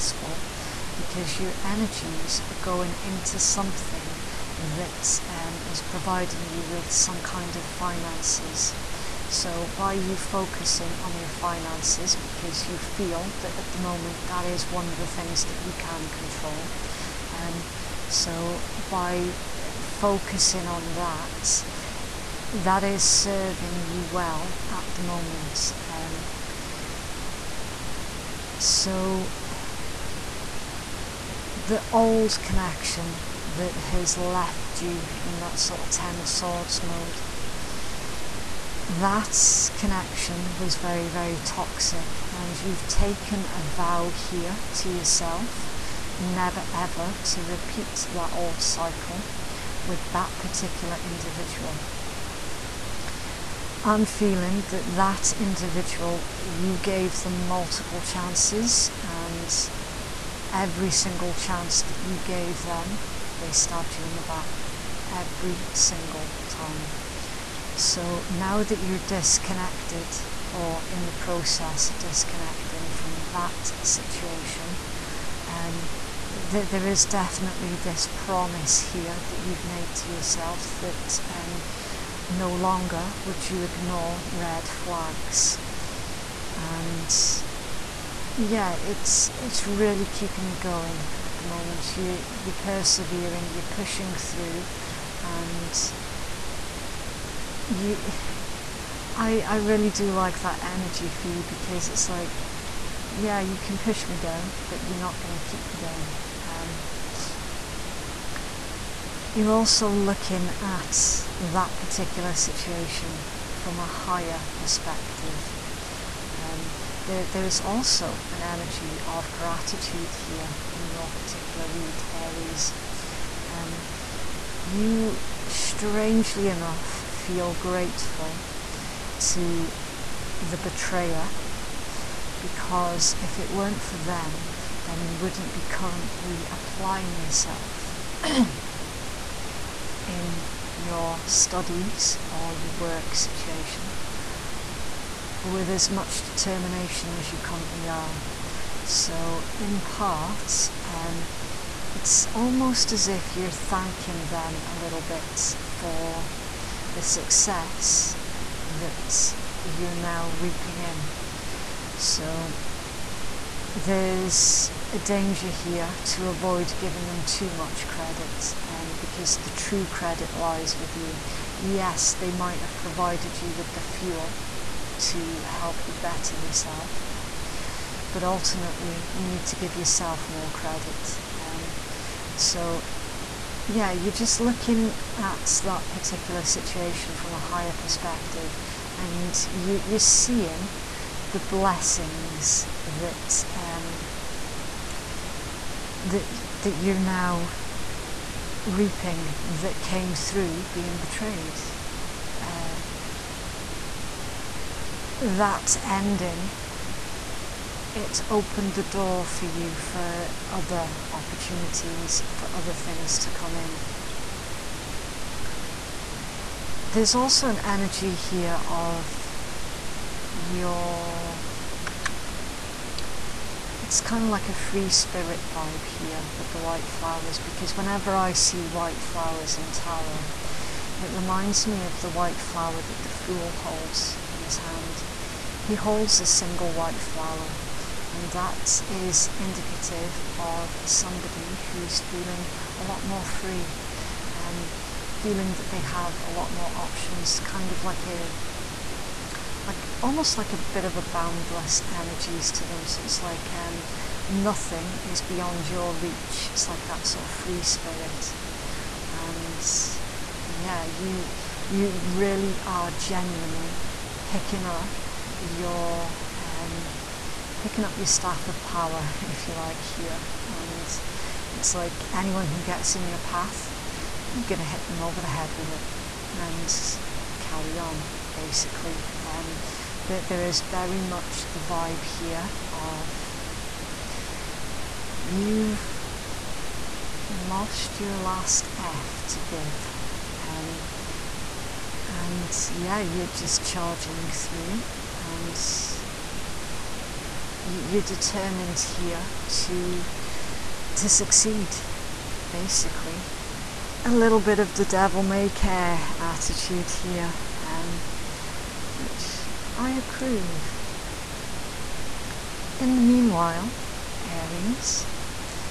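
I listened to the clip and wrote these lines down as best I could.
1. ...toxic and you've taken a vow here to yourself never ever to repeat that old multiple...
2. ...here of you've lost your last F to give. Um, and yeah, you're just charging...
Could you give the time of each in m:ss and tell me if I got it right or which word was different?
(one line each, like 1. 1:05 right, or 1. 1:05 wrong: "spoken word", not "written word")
1. 0:41 wrong: "cycle", not "multiple"
2. 4:42 right.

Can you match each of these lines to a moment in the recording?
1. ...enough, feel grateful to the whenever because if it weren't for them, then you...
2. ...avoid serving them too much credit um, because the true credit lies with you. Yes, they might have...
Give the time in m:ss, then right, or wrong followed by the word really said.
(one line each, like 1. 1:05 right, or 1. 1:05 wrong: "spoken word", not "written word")
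1. 2:06 wrong: "betrayer", not "whenever"
2. 2:46 wrong: "giving", not "serving".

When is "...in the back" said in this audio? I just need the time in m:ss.
1:04.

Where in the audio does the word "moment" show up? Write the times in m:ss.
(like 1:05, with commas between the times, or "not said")
0:13, 0:25, 1:31.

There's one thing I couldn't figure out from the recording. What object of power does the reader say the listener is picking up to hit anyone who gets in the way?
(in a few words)
Staff.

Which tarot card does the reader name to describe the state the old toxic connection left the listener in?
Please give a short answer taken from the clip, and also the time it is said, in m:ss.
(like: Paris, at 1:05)
Ten of Swords, at 0:35.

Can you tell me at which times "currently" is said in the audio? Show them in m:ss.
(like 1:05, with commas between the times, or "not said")
2:15, 2:27.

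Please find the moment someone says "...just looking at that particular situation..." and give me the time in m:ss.
3:04.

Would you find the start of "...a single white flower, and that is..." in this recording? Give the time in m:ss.
3:56.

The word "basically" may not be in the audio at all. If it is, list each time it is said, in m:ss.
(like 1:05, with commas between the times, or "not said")
4:38, 5:02.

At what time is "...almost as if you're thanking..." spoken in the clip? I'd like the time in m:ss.
2:32.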